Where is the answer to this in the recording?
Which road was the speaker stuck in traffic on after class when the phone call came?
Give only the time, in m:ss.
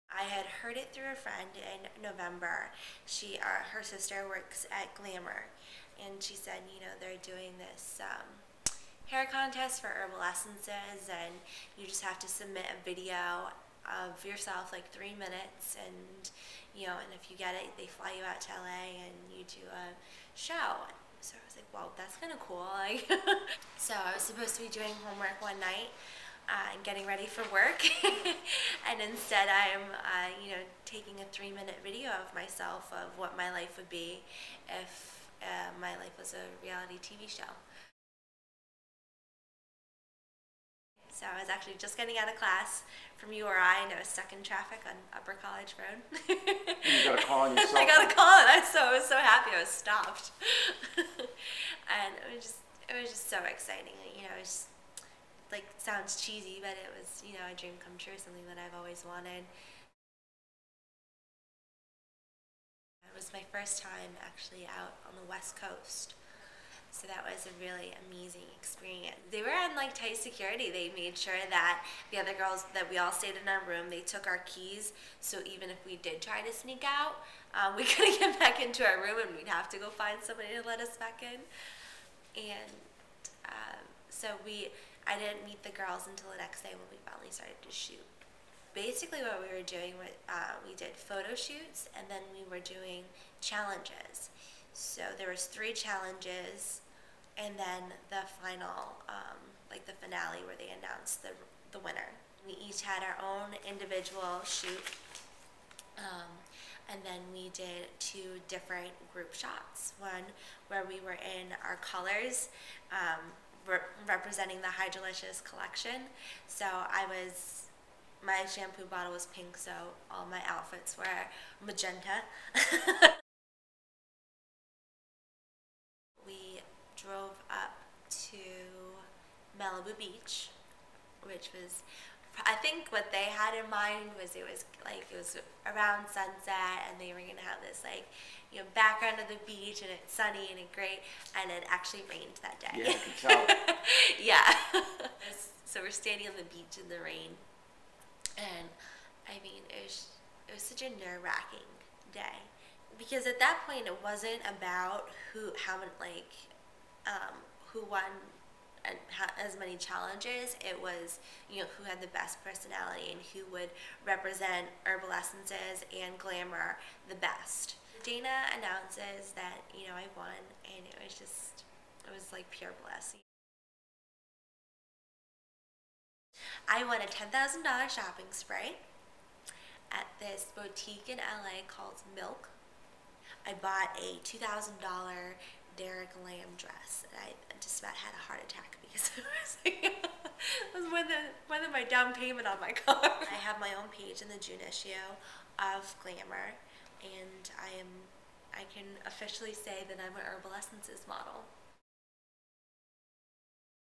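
0:45.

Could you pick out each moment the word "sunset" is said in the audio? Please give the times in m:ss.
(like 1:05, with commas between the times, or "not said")
2:16.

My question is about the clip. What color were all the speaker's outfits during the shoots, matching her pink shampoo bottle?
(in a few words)
magenta.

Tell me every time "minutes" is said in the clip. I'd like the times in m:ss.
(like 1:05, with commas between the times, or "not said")
0:15, 0:31.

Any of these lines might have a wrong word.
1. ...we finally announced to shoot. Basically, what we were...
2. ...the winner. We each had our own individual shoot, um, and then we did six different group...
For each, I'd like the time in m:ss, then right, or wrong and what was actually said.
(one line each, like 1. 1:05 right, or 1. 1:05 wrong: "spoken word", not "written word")
1. 1:26 wrong: "started", not "announced"
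2. 1:41 wrong: "two", not "six".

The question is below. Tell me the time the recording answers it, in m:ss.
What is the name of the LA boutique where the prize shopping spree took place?
3:02.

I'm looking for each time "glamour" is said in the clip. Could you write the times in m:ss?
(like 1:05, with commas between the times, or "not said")
0:04, 2:46, 3:16.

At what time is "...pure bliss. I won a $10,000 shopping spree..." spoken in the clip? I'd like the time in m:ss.
2:52.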